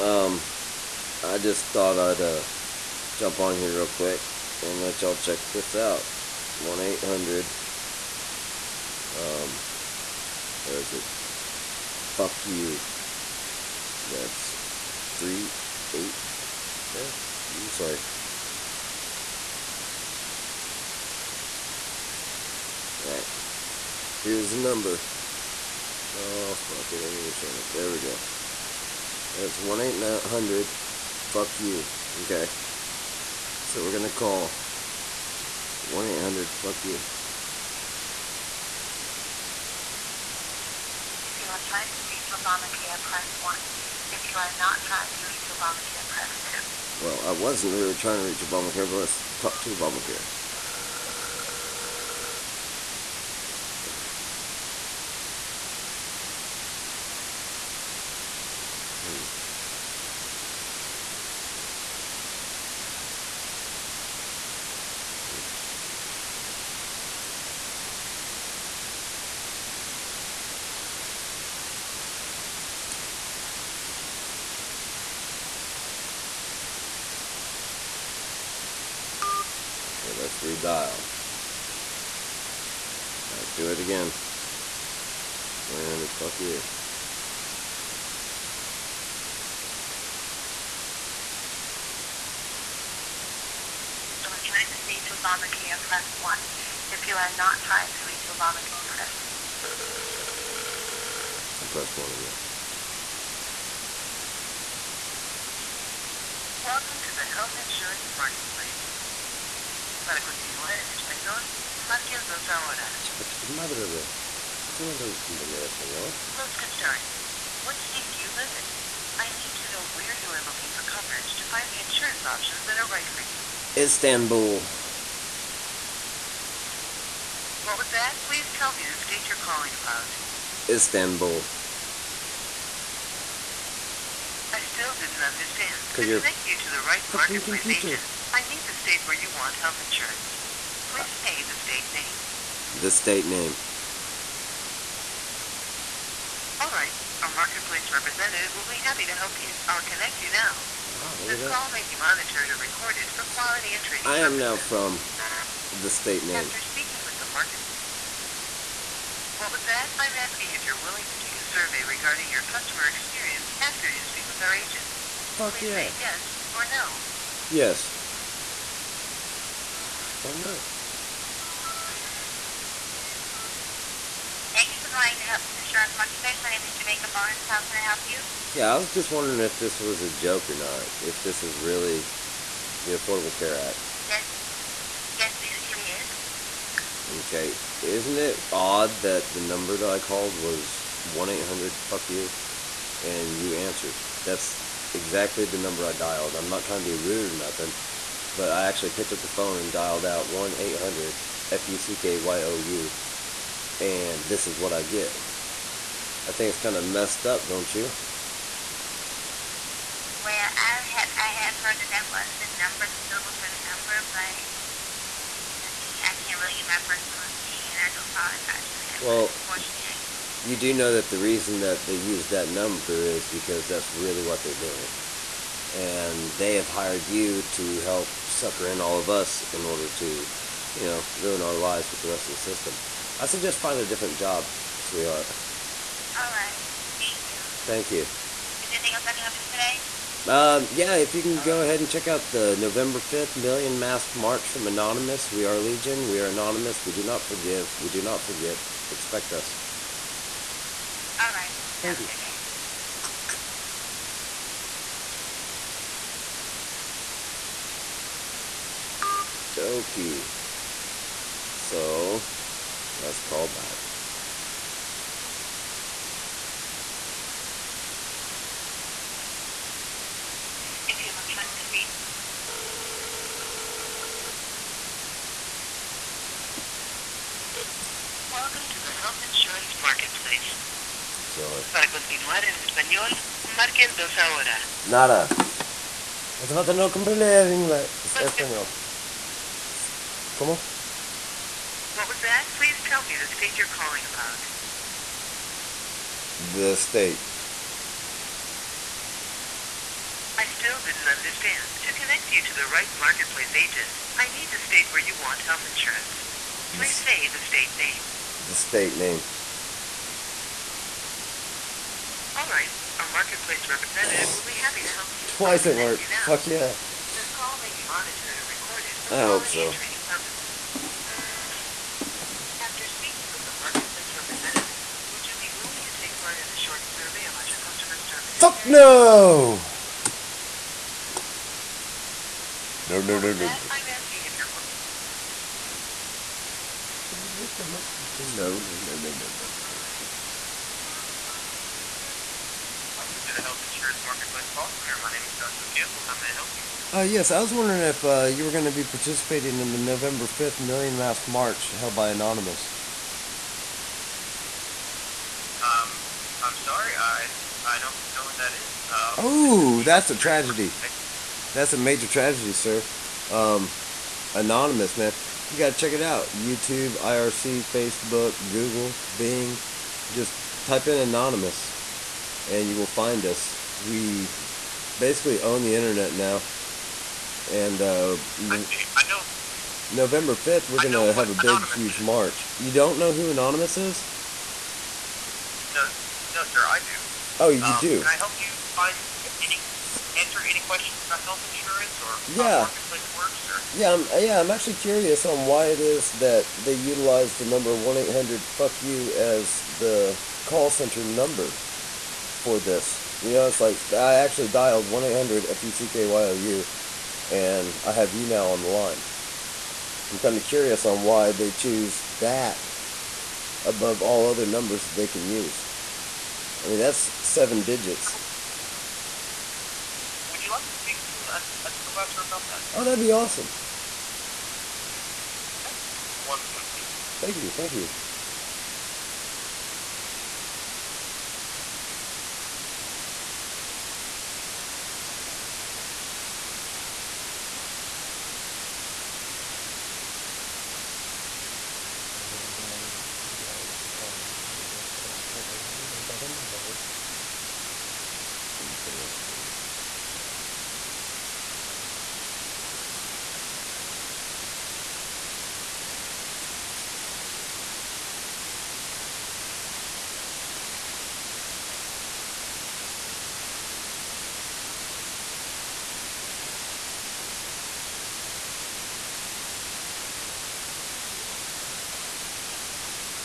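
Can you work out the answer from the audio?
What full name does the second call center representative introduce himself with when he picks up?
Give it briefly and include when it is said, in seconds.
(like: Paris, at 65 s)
Joshua Campbell, at 345 s.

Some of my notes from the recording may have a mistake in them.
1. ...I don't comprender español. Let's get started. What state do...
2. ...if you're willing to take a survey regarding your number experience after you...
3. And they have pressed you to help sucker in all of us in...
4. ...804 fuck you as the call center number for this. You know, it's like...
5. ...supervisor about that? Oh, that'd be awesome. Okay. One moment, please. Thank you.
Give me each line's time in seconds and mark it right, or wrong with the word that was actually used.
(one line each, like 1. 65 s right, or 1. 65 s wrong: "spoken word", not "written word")
1. 114 s right
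2. 160 s wrong: "customer", not "number"
3. 225 s wrong: "hired", not "pressed"
4. 397 s wrong: "800", not "804"
5. 421 s right.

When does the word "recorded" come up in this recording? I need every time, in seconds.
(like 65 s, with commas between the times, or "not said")
152 s, 318 s.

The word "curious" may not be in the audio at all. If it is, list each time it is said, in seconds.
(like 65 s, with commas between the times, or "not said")
394 s, 410 s.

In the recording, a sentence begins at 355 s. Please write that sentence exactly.
Um, I'm sorry, I, I don't know what that is.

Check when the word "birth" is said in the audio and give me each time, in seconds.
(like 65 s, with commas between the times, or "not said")
not said.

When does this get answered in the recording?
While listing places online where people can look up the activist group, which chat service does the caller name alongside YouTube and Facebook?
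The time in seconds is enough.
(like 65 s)
366 s.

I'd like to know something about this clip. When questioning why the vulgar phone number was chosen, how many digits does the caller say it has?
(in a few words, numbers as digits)
7.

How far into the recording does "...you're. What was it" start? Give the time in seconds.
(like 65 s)
334 s.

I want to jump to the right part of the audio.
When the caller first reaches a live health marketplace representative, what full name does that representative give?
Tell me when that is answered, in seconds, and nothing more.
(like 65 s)
176 s.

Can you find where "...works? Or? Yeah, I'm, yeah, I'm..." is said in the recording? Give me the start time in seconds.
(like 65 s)
393 s.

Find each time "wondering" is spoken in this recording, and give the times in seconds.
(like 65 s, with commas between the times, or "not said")
179 s, 347 s.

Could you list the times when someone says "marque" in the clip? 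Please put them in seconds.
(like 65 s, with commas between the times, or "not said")
111 s, 283 s.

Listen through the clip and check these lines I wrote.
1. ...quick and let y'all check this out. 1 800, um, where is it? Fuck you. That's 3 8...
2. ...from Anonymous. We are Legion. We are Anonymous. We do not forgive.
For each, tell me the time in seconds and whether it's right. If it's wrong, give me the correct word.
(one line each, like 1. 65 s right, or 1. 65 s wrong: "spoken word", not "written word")
1. 3 s right
2. 244 s right.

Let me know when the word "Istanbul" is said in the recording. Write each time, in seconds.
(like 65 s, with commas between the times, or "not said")
123 s, 130 s.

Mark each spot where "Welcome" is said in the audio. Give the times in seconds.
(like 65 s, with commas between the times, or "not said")
106 s, 278 s.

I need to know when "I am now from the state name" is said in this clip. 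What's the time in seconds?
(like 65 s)
154 s.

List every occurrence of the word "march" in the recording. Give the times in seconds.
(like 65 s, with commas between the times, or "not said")
244 s, 351 s, 382 s.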